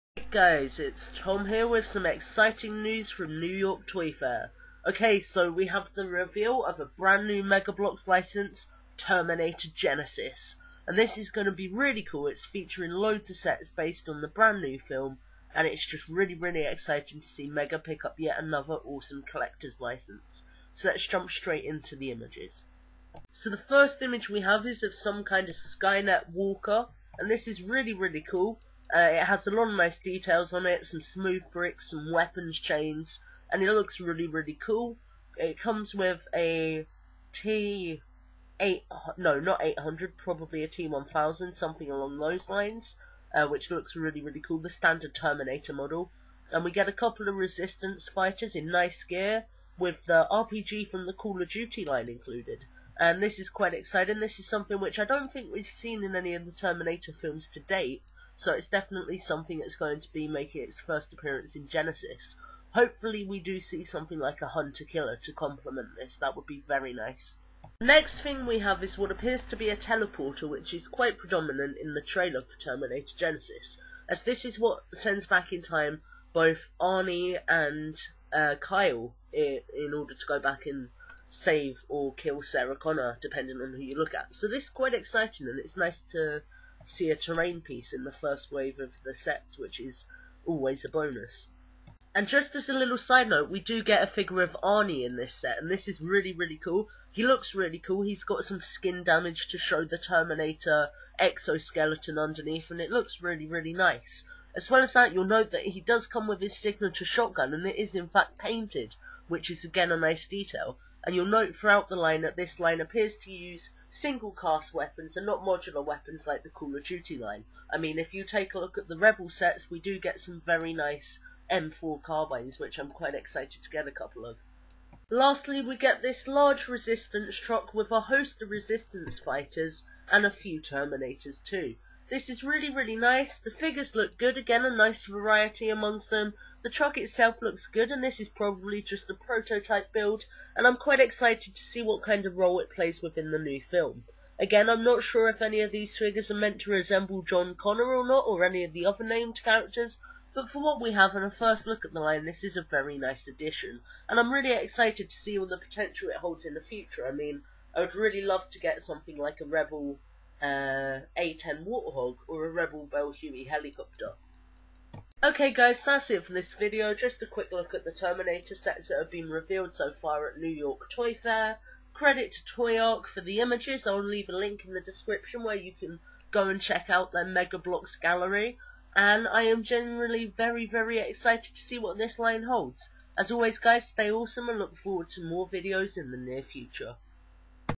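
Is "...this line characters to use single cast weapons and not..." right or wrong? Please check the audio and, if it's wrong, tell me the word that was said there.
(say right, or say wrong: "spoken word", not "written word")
wrong: "appears", not "characters".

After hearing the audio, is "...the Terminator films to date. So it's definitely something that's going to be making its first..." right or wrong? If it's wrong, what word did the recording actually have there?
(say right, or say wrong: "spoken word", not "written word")
right.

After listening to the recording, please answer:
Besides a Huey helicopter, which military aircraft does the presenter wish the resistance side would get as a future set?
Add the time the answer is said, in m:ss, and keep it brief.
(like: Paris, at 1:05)
A10 Warthog, at 2:41.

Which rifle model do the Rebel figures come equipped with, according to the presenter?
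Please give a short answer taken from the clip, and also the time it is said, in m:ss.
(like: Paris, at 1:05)
M4 carbines, at 2:01.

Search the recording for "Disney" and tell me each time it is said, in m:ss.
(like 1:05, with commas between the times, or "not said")
not said.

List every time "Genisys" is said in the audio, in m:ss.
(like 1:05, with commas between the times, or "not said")
0:09, 1:01, 1:13.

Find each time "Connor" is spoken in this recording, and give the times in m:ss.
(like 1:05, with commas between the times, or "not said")
1:22, 2:27.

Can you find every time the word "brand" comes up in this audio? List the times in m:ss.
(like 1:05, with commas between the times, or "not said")
0:06, 0:14.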